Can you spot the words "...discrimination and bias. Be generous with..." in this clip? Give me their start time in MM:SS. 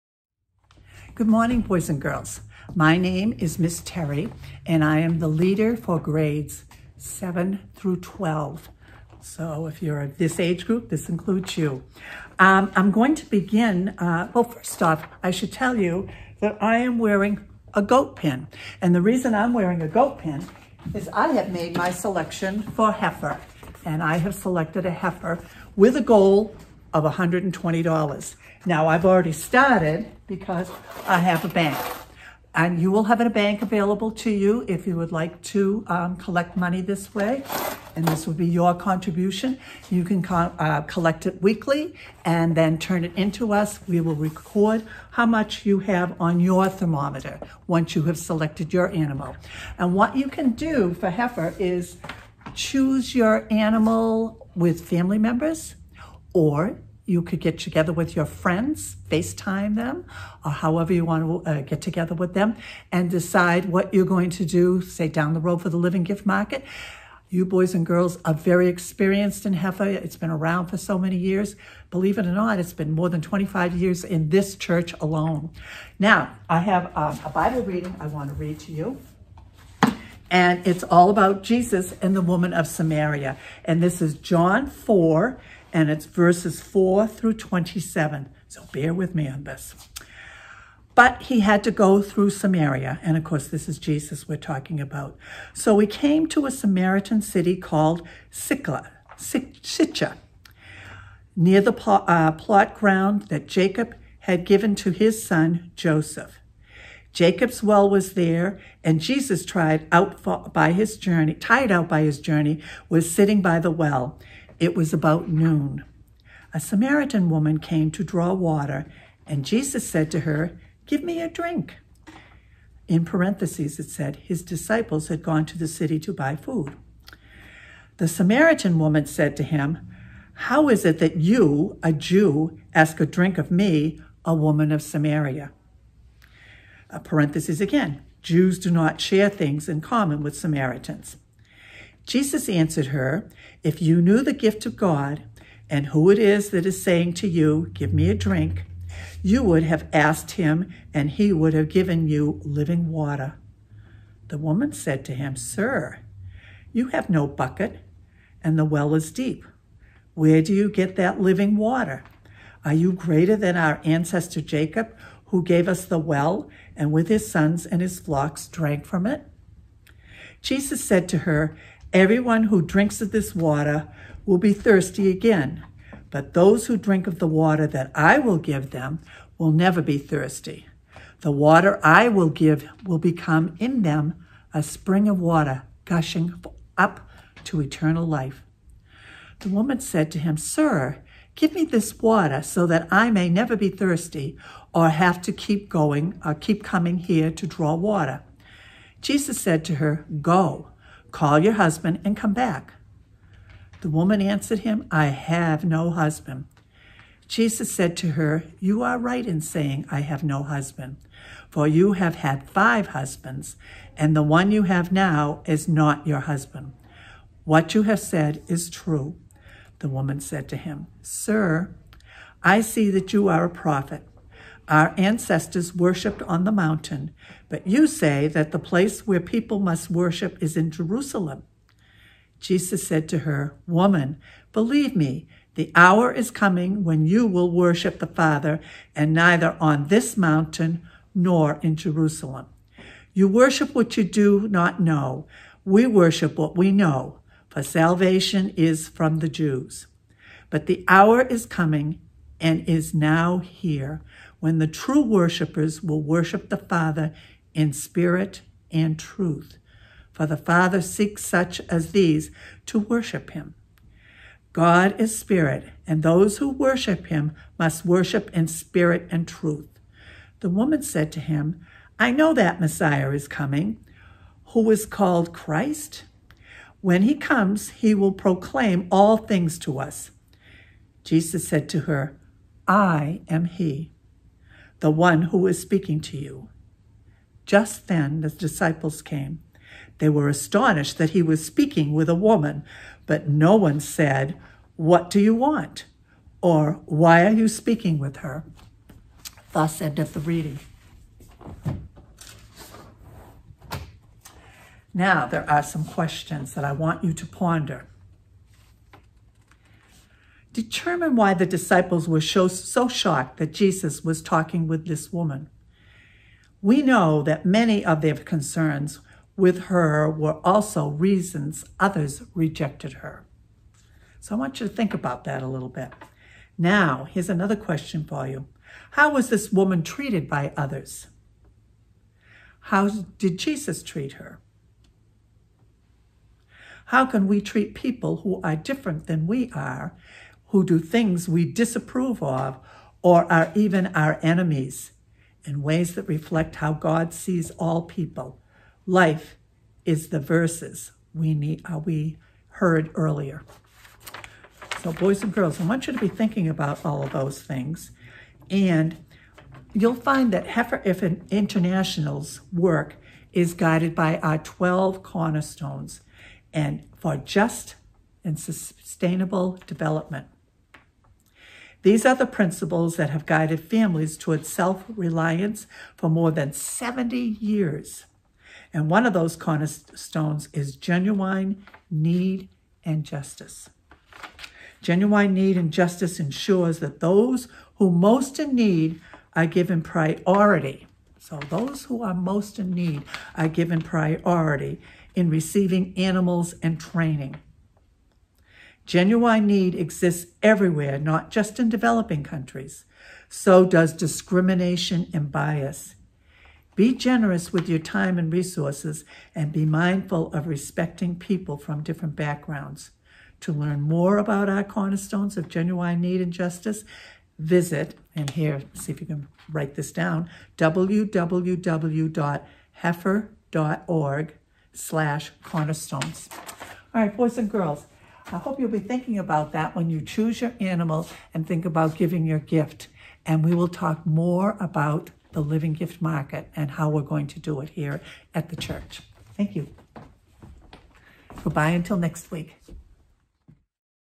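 06:43.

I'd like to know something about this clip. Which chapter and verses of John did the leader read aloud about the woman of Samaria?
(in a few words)
John 4:4-27.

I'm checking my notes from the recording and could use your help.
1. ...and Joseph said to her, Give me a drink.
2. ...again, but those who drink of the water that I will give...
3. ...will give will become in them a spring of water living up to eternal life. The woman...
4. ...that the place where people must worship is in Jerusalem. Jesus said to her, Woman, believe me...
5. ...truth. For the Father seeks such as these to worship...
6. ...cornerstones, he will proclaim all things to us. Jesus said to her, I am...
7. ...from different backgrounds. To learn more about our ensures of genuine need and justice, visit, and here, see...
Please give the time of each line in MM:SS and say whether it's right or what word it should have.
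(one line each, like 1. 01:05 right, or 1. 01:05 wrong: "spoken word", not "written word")
1. 01:59 wrong: "Jesus", not "Joseph"
2. 02:55 right
3. 03:02 wrong: "gushing", not "living"
4. 03:48 right
5. 04:18 right
6. 04:37 wrong: "comes", not "cornerstones"
7. 06:51 wrong: "cornerstones", not "ensures".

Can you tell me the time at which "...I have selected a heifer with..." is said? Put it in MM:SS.
00:24.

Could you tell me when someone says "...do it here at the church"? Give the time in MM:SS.
07:17.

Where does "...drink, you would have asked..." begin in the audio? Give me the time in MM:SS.
02:28.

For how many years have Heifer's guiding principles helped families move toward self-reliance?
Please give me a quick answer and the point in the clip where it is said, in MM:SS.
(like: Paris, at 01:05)
More than 70 years, at 06:16.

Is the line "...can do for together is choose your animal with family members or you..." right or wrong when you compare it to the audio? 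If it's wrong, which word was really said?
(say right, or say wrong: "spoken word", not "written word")
wrong: "heifer", not "together".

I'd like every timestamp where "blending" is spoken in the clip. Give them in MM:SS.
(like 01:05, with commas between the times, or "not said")
not said.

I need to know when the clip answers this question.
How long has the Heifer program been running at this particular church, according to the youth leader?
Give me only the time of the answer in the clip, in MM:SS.
01:12.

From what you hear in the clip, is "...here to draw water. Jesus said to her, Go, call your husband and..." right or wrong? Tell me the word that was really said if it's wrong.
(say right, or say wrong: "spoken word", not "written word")
right.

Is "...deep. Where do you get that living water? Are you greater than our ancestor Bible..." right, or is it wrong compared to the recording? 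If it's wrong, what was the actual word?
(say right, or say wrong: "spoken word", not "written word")
wrong: "Jacob", not "Bible".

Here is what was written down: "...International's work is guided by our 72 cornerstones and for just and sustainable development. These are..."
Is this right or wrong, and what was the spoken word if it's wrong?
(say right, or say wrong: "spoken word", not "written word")
wrong: "12", not "72".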